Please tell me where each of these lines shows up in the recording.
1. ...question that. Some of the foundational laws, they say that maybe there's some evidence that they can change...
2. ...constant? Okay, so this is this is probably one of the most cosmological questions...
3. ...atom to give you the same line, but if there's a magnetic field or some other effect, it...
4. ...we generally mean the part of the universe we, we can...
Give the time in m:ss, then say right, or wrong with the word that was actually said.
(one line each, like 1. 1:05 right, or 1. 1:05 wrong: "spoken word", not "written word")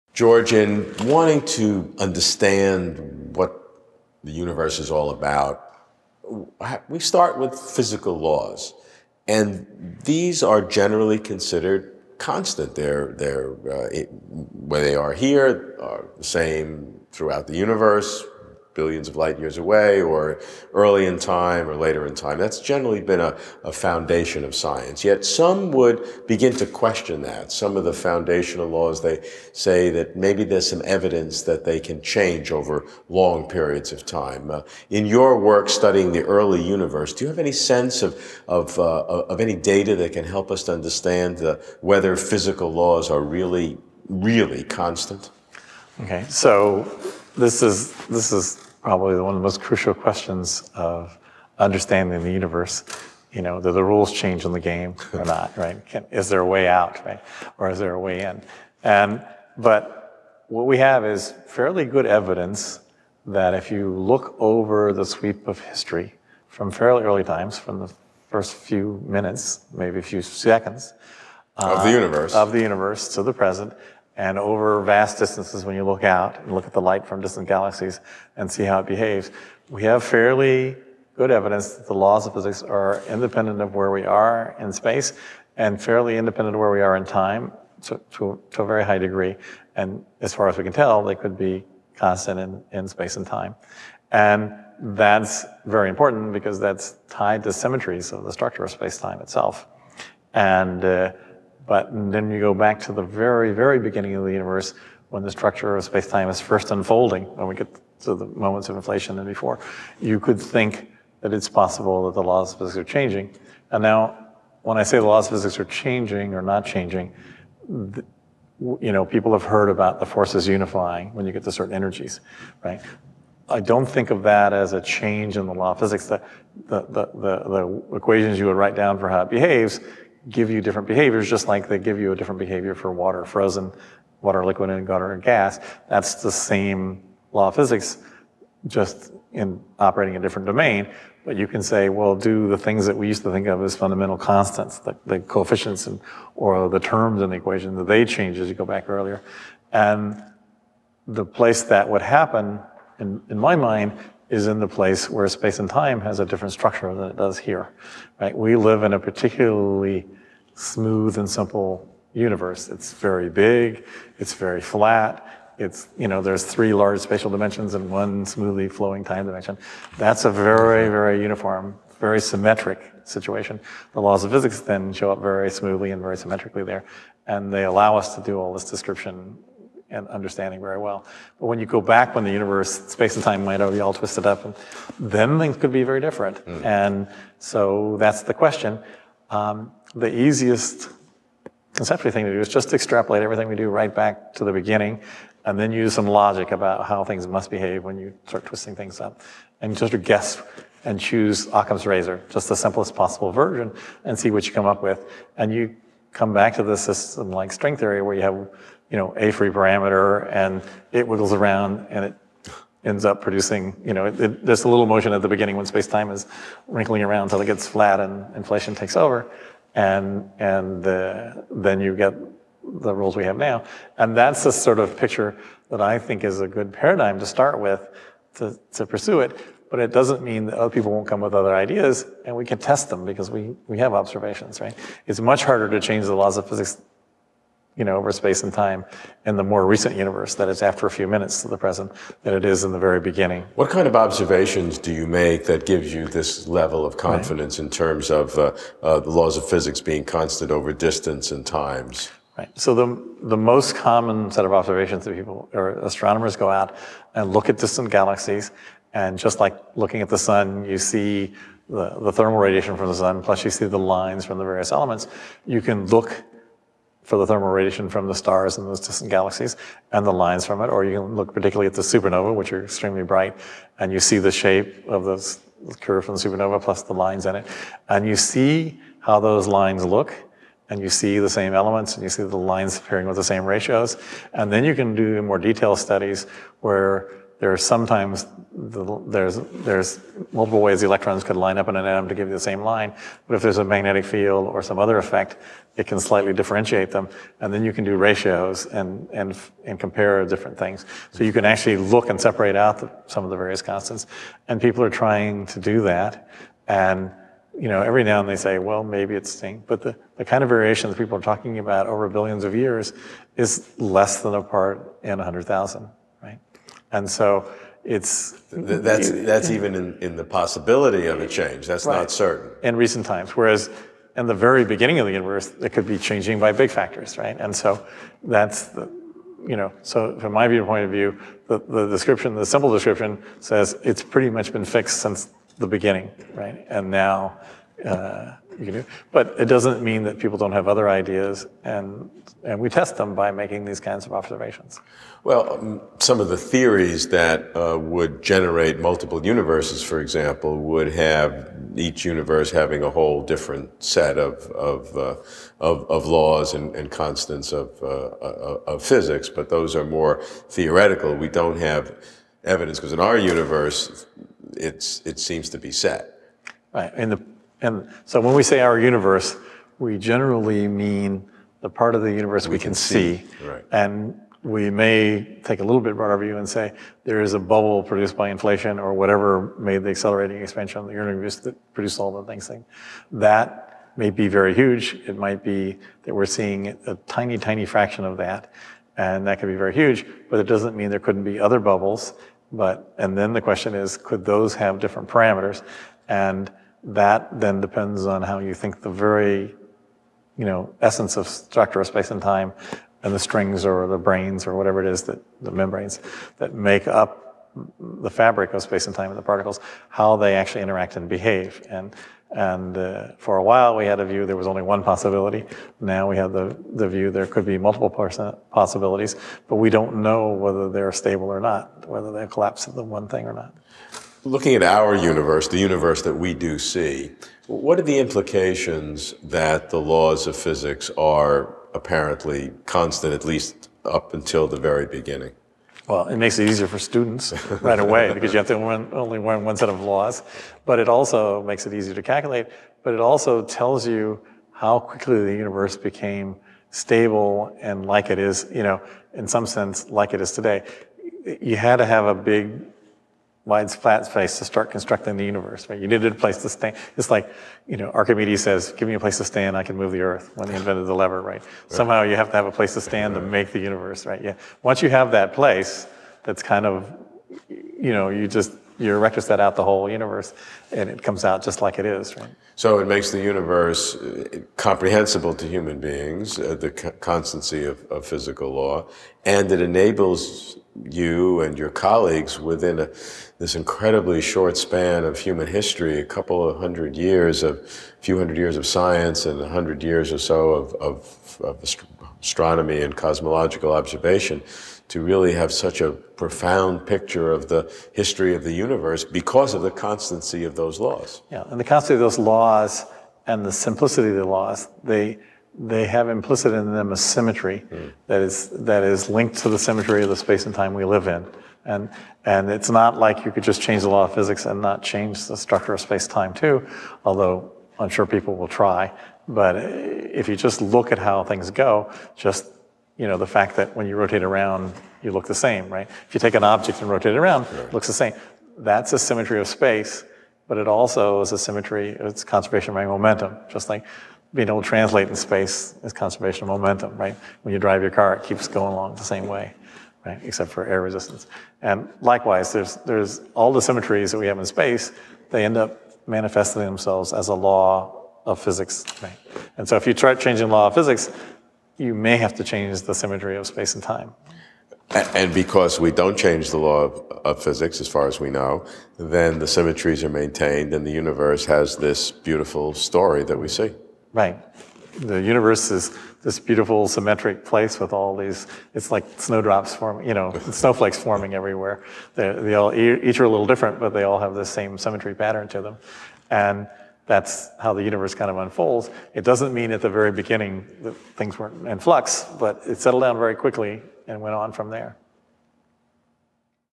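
1. 0:26 right
2. 0:44 wrong: "crucial", not "cosmological"
3. 4:51 right
4. 6:09 right.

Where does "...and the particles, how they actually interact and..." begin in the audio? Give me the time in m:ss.
6:49.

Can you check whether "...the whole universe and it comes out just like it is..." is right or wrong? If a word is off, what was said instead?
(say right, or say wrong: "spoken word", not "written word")
right.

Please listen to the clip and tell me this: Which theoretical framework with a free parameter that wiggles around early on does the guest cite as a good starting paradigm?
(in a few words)
string theory.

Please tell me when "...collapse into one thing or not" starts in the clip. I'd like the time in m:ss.
7:02.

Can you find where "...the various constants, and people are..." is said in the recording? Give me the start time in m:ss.
5:03.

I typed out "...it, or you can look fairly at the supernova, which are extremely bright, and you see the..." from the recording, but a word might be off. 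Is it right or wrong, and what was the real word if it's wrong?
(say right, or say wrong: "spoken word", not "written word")
wrong: "particularly", not "fairly".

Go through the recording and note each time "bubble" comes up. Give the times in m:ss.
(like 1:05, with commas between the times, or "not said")
6:17, 6:31.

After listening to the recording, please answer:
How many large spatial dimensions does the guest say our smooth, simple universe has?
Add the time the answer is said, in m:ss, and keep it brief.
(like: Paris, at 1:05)
3, at 2:46.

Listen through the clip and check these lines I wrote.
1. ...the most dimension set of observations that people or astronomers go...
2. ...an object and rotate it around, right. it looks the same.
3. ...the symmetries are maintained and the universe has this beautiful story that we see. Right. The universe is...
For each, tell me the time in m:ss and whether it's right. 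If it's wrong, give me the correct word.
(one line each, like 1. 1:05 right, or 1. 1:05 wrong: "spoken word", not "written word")
1. 4:13 wrong: "common", not "dimension"
2. 8:46 right
3. 9:19 right.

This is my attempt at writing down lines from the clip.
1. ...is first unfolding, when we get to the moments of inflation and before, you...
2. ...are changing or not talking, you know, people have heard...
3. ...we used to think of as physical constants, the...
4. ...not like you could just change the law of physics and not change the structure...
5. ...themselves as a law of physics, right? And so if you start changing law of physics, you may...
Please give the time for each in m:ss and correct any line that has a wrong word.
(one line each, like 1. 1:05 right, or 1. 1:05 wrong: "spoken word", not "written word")
1. 1:46 right
2. 1:55 wrong: "changing", not "talking"
3. 2:22 wrong: "fundamental", not "physical"
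4. 8:32 right
5. 9:06 right.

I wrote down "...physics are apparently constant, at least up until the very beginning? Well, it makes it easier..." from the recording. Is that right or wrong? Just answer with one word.
right.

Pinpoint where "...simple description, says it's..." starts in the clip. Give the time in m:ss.
5:32.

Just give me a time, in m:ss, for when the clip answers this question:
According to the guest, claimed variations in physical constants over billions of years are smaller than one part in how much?
5:15.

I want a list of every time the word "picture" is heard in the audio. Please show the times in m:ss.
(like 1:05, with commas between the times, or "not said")
3:44, 8:16.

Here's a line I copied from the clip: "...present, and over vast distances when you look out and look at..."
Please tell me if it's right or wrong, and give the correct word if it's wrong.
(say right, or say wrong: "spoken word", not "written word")
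right.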